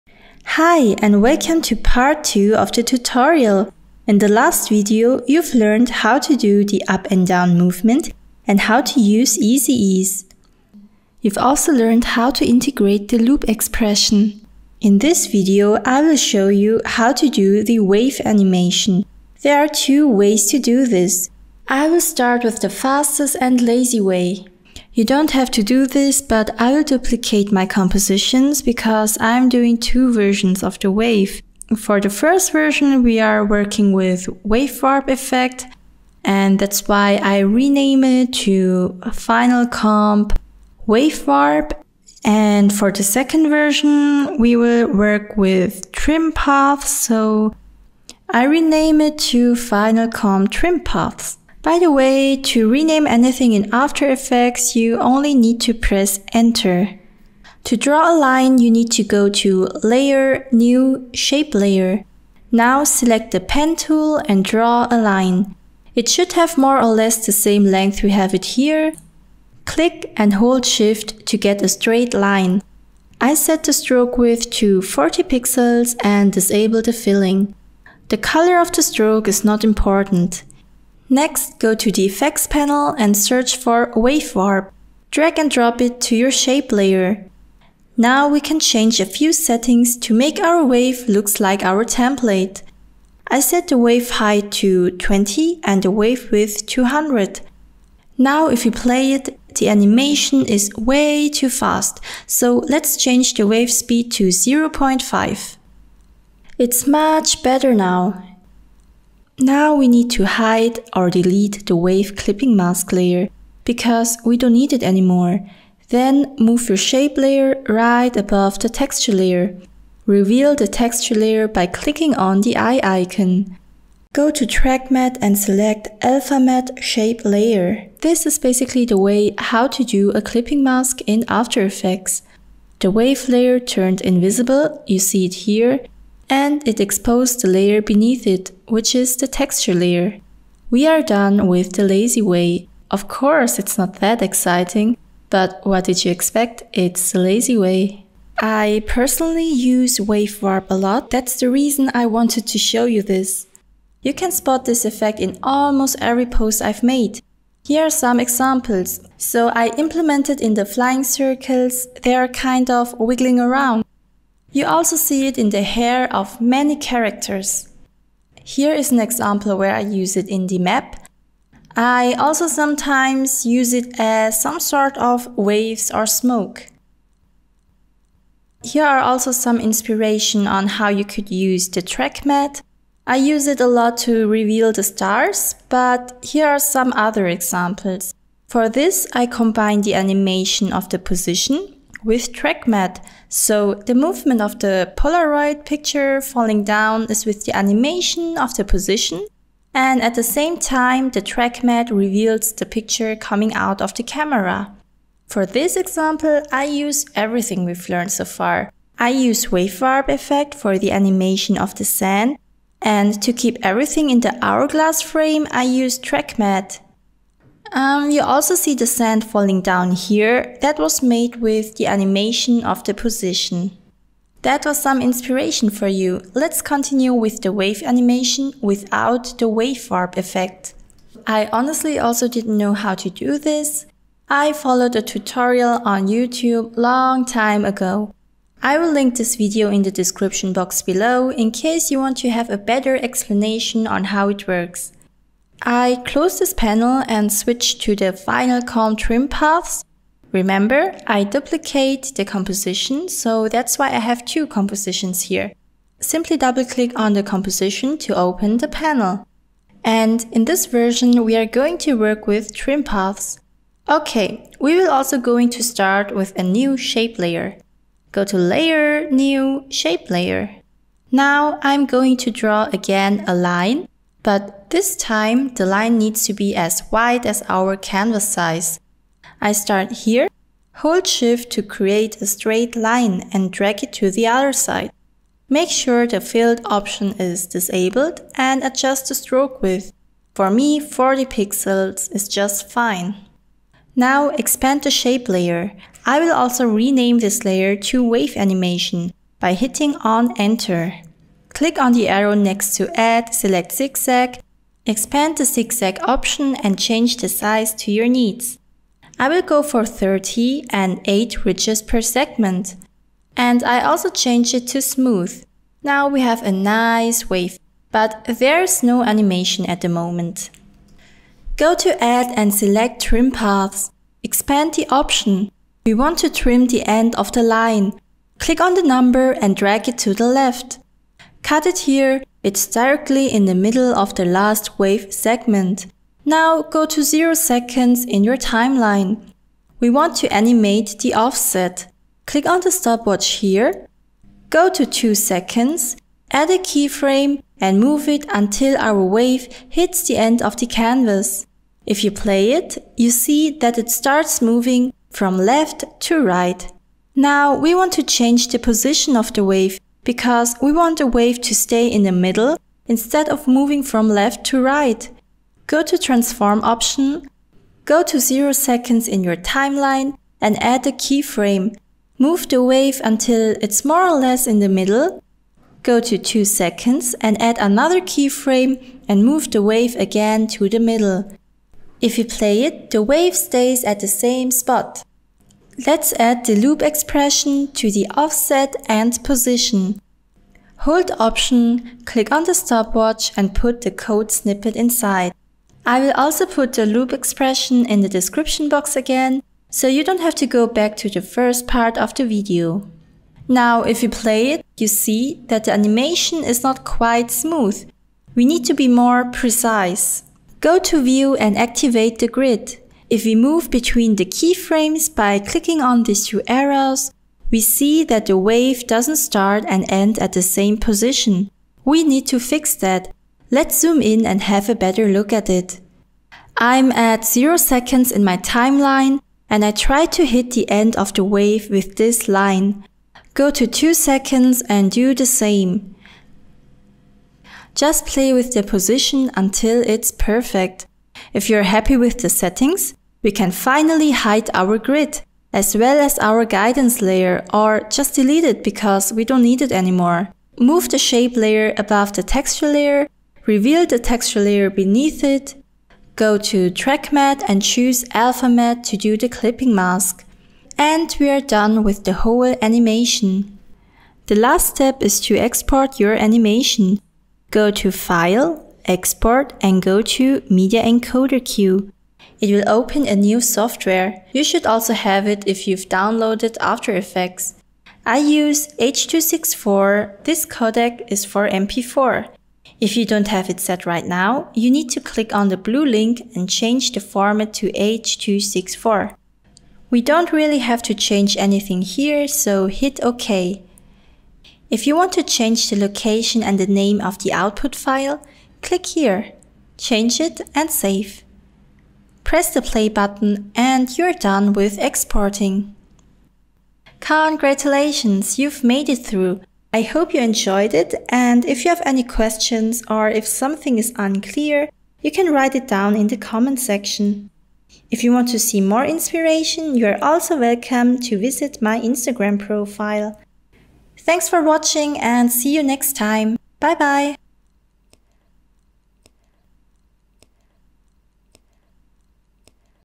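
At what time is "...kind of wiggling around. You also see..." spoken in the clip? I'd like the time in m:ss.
2:42.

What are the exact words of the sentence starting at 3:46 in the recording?
Let's continue with the wave animation without the wave warp effect.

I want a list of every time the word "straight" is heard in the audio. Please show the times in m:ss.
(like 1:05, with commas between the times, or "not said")
1:11, 4:42.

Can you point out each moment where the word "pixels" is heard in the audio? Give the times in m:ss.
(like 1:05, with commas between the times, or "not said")
1:15, 4:51.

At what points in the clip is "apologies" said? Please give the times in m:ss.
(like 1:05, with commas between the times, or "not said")
not said.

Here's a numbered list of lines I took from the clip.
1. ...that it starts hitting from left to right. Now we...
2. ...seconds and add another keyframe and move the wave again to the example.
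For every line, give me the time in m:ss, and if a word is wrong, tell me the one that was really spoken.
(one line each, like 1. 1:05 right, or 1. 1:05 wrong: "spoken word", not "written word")
1. 5:53 wrong: "moving", not "hitting"
2. 6:16 wrong: "middle", not "example".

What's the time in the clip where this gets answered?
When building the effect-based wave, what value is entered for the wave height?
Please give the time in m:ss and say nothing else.
1:34.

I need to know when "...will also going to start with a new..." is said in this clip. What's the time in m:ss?
4:24.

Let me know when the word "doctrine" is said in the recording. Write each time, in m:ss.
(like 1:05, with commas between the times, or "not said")
not said.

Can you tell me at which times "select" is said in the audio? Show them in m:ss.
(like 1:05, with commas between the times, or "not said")
1:02, 2:05, 5:03, 5:22.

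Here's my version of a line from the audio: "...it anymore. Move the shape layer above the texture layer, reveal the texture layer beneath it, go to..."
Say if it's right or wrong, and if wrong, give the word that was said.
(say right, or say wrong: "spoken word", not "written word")
right.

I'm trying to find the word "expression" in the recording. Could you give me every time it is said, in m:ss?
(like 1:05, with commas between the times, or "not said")
0:13, 6:26, 6:37.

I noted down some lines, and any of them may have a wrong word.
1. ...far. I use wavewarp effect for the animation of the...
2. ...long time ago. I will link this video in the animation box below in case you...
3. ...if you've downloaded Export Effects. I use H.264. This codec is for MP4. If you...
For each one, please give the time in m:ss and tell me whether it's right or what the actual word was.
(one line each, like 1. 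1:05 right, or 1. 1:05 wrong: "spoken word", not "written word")
1. 3:28 right
2. 3:56 wrong: "description", not "animation"
3. 7:55 wrong: "After", not "Export".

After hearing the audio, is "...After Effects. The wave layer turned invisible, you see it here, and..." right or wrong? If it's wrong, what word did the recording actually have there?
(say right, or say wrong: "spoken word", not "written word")
right.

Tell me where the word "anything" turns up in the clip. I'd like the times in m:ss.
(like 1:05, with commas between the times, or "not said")
0:53, 8:11.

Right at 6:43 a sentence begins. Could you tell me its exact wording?
Now if you play it, you see that the animation is not quite smooth.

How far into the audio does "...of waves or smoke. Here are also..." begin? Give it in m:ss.
2:54.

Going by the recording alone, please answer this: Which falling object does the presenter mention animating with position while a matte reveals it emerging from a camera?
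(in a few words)
Polaroid picture.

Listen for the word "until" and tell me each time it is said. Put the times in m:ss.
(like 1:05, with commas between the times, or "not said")
5:48, 6:13, 7:19.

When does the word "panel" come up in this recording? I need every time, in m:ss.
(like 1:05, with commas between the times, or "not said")
1:22, 4:06, 4:18.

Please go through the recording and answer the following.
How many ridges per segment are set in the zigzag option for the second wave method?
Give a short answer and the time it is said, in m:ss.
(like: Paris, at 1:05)
8, at 5:11.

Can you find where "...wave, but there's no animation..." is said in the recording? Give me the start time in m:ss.
5:17.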